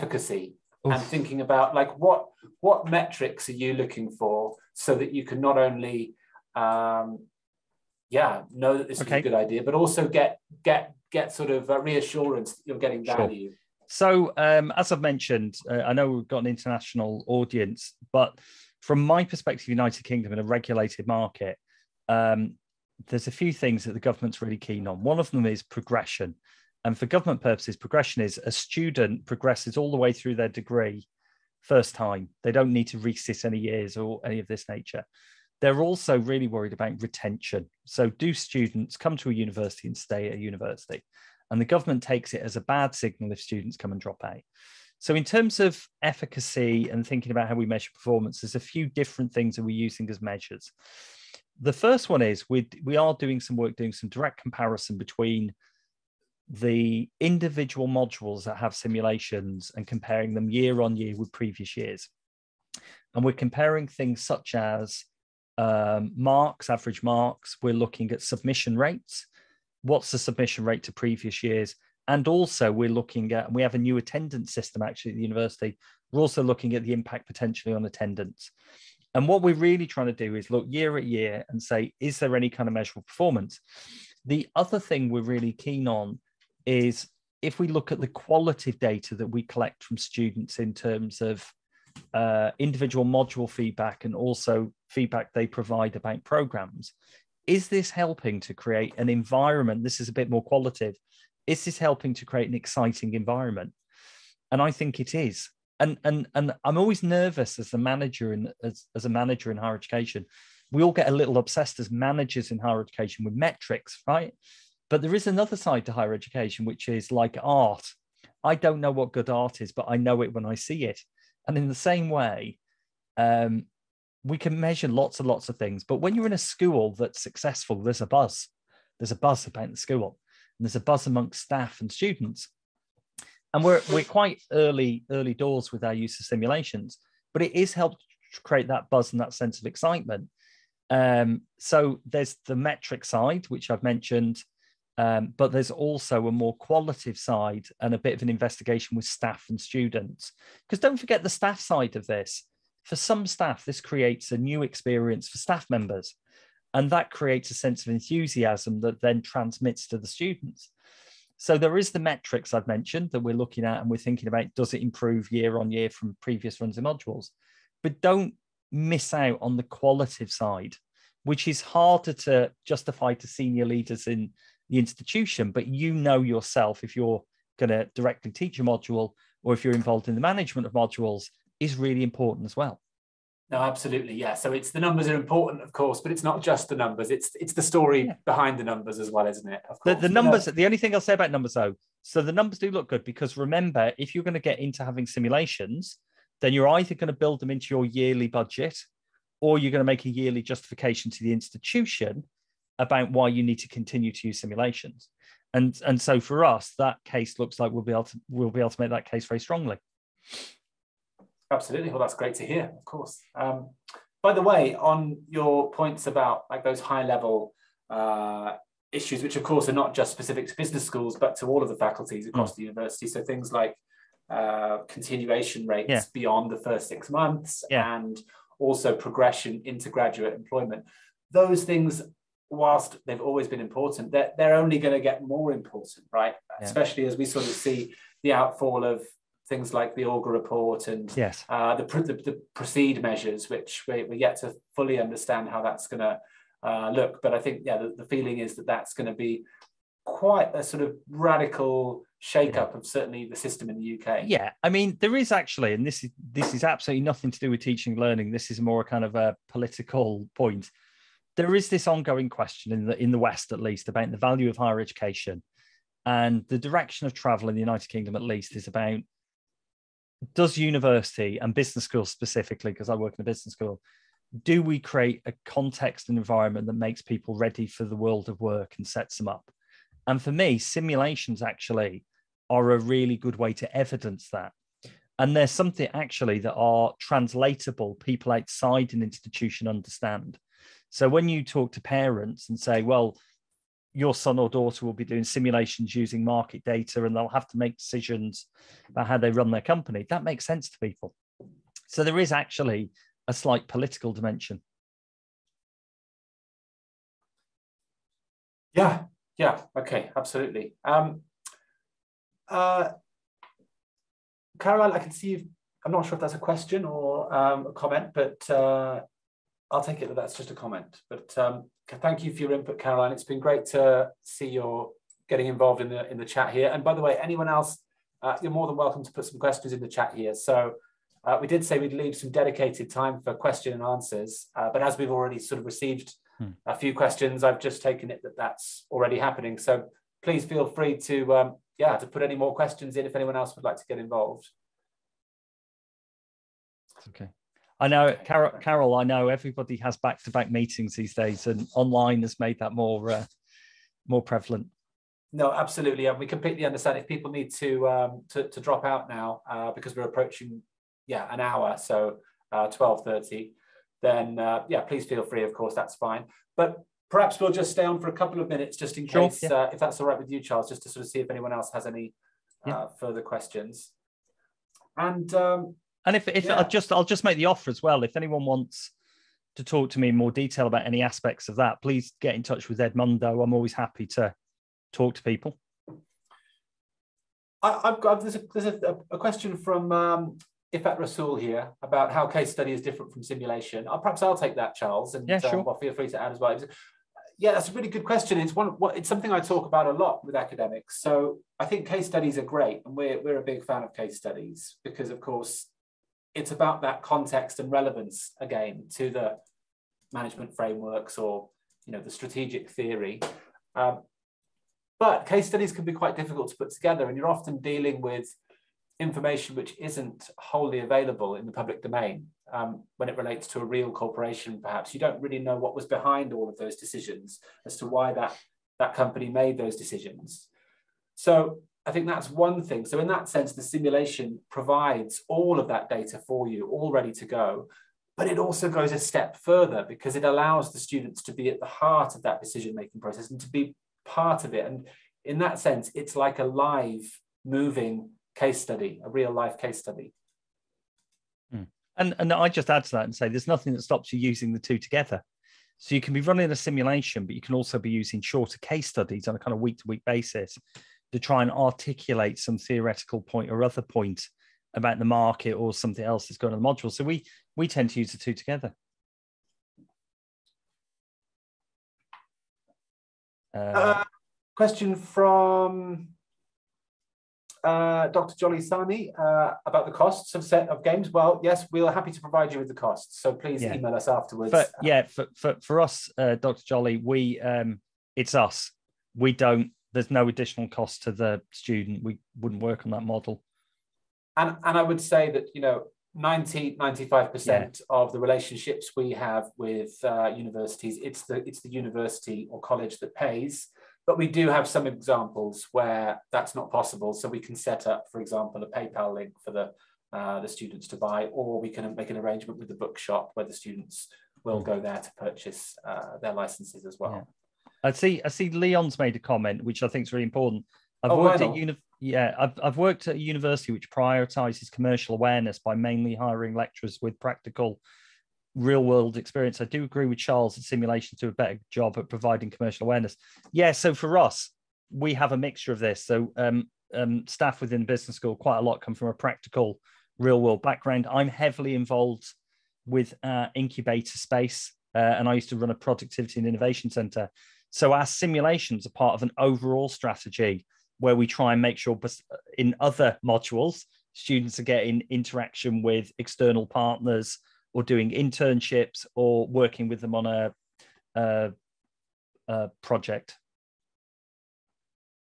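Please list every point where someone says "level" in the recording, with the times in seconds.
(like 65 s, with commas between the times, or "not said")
217 s.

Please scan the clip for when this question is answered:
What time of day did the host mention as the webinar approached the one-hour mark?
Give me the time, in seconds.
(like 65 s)
362 s.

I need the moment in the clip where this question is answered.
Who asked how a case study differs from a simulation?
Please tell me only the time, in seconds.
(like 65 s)
390 s.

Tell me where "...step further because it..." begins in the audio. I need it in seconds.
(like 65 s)
438 s.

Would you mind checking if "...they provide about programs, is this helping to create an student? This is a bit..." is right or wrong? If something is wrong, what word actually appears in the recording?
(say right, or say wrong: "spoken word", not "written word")
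wrong: "environment", not "student".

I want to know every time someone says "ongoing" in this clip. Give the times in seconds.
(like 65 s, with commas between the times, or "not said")
261 s.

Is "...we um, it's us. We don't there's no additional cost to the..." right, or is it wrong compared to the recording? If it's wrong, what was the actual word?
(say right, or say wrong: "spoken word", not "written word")
right.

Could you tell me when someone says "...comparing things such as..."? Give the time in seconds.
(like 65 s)
63 s.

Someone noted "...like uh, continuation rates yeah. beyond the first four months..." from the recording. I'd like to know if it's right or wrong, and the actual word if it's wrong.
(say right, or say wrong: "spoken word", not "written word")
wrong: "six", not "four".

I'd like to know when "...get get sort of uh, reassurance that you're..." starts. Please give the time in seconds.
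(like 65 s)
10 s.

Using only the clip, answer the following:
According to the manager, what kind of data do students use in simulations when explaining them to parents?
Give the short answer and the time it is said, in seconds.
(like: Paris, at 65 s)
market data, at 296 s.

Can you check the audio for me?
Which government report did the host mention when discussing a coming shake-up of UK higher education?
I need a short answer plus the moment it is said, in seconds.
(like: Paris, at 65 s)
Augar report, at 240 s.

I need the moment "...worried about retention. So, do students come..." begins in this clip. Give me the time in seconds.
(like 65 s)
36 s.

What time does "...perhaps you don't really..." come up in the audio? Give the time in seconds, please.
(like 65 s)
424 s.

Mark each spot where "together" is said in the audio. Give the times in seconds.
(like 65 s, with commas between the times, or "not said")
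416 s, 454 s, 468 s.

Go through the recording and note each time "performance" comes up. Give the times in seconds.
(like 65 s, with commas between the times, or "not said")
47 s, 83 s.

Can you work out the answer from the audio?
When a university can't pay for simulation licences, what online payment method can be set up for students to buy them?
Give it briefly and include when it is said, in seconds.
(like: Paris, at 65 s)
PayPal, at 508 s.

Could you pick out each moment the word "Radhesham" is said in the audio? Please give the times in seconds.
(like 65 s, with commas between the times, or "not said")
not said.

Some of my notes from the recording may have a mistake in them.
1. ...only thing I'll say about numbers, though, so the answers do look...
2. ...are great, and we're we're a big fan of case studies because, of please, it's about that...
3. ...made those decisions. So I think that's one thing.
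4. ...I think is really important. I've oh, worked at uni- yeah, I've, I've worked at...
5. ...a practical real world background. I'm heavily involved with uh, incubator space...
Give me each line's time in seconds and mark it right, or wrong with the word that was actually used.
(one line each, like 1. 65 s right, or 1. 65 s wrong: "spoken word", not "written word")
1. 190 s wrong: "numbers", not "answers"
2. 402 s wrong: "course", not "please"
3. 429 s right
4. 519 s right
5. 539 s right.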